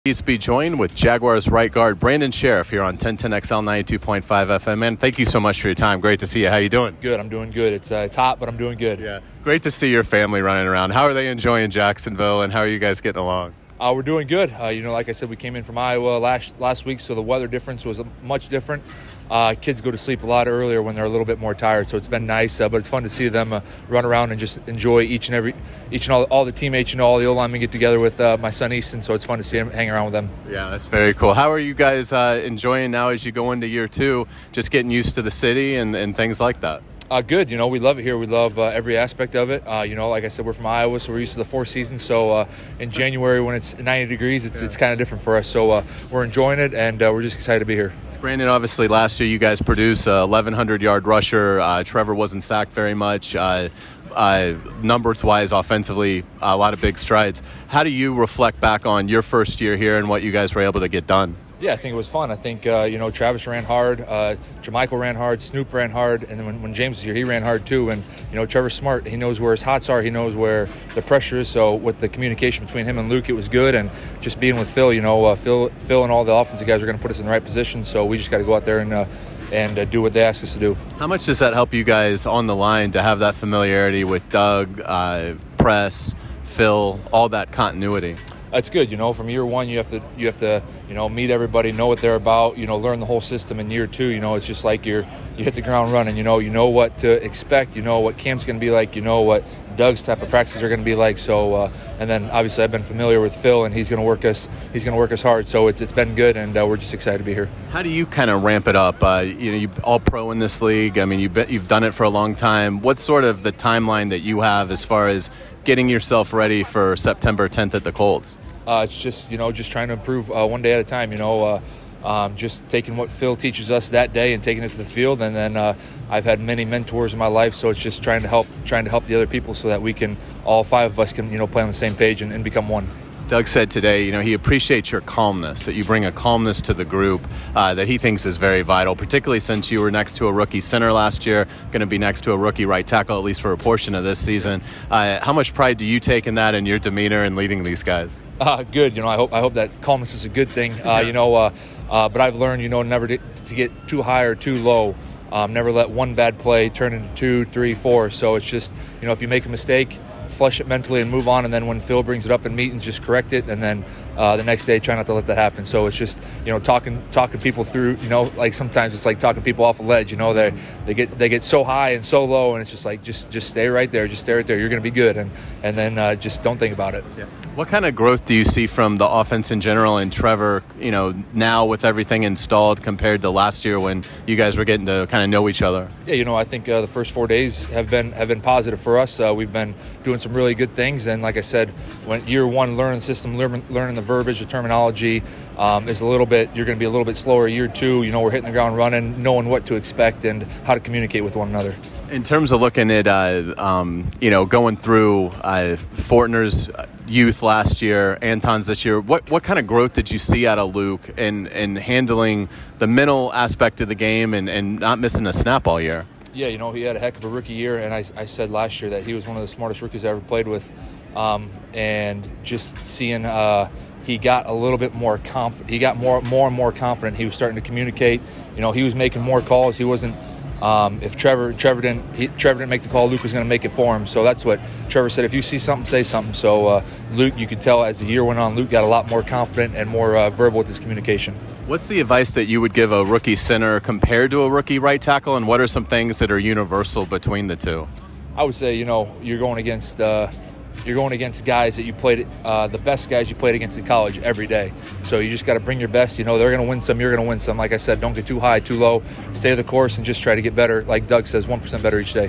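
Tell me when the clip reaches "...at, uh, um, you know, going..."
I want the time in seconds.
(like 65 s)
202 s.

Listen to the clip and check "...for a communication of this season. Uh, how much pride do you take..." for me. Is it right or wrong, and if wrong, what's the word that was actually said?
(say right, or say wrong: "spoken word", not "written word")
wrong: "portion", not "communication".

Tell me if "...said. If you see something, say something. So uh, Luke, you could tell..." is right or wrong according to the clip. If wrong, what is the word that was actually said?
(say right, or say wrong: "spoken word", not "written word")
right.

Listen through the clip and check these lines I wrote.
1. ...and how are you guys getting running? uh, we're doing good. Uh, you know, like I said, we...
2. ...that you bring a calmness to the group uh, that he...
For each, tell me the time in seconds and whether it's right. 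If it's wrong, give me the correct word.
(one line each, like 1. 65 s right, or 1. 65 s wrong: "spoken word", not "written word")
1. 12 s wrong: "along", not "running"
2. 135 s right.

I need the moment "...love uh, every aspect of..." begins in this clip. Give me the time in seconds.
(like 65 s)
38 s.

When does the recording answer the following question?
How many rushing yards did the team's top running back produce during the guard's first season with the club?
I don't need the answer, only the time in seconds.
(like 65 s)
50 s.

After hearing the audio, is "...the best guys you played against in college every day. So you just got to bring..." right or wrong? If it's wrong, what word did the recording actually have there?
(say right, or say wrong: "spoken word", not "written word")
right.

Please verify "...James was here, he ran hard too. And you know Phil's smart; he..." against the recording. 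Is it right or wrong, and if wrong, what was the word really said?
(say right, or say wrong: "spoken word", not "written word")
wrong: "Trevor", not "Phil".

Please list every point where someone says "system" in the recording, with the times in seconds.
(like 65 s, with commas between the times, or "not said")
93 s, 193 s.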